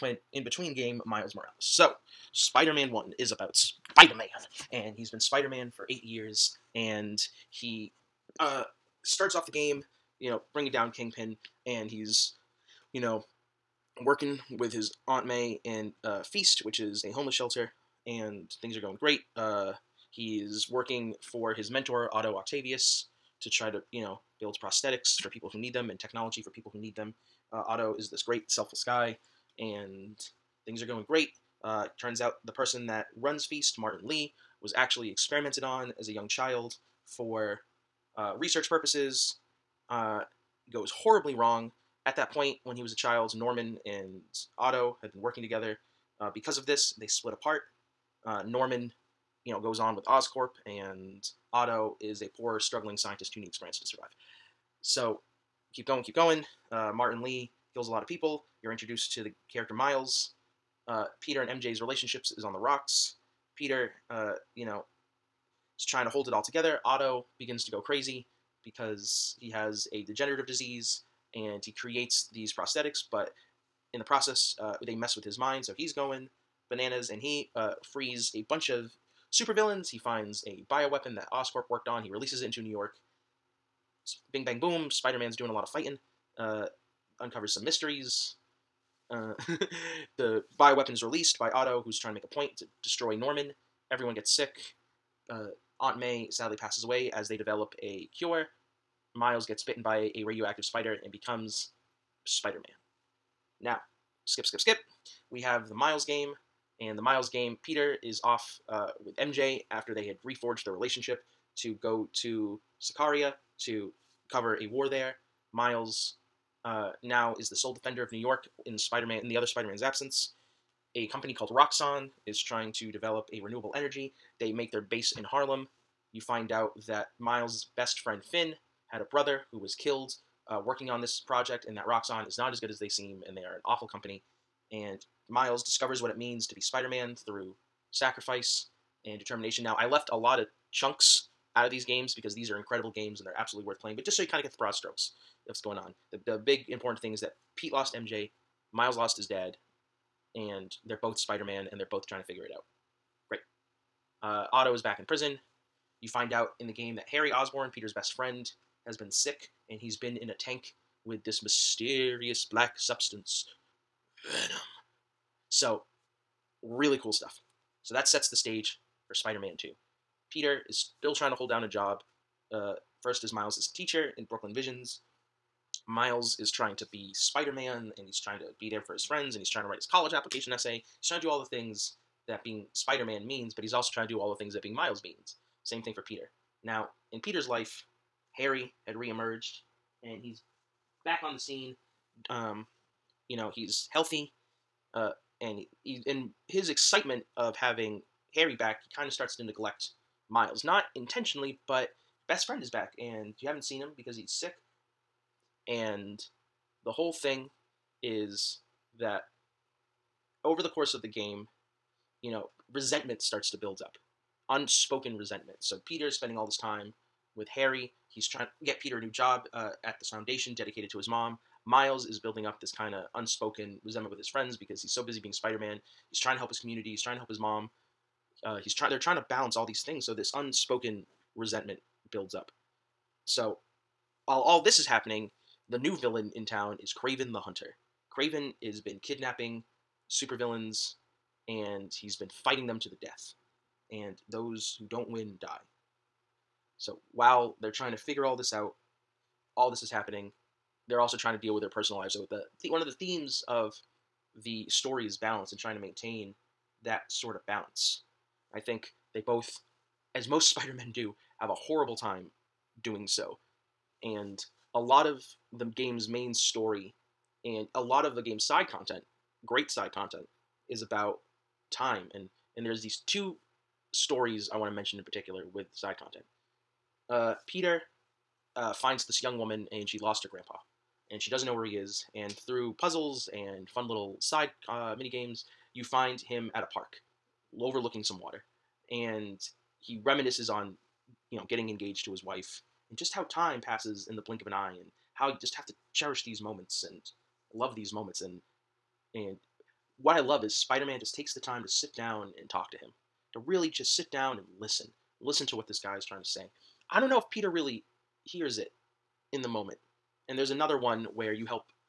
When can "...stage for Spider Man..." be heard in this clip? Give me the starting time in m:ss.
2:48.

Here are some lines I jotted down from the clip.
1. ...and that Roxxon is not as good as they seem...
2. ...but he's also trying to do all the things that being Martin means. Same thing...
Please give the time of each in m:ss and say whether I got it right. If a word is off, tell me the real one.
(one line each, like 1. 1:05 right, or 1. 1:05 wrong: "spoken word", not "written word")
1. 2:11 right
2. 3:03 wrong: "Miles", not "Martin".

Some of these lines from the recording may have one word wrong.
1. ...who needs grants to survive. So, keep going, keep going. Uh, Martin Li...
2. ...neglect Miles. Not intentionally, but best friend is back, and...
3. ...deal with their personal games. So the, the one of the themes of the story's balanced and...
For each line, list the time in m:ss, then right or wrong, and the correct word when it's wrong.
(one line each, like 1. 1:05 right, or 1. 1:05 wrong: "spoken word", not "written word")
1. 0:53 right
2. 3:19 right
3. 4:11 wrong: "lives", not "games".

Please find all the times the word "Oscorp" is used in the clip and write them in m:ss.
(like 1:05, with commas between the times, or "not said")
0:50, 1:21.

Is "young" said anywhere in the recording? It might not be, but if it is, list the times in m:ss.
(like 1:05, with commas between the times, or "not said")
0:36, 4:39.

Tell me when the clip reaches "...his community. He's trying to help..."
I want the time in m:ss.
3:46.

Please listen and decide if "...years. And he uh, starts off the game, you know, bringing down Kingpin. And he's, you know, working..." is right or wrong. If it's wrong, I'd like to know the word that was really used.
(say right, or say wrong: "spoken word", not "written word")
right.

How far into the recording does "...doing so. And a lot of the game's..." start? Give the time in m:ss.
4:22.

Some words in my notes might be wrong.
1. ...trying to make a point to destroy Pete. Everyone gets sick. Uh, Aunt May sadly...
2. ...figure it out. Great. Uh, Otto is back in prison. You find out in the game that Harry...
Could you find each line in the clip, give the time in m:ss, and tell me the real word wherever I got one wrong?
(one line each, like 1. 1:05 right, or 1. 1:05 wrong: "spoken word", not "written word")
1. 1:31 wrong: "Norman", not "Pete"
2. 2:32 right.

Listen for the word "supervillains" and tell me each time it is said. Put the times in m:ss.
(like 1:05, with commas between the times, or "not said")
1:19, 4:00.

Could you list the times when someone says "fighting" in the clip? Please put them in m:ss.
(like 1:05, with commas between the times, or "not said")
1:25, 4:02.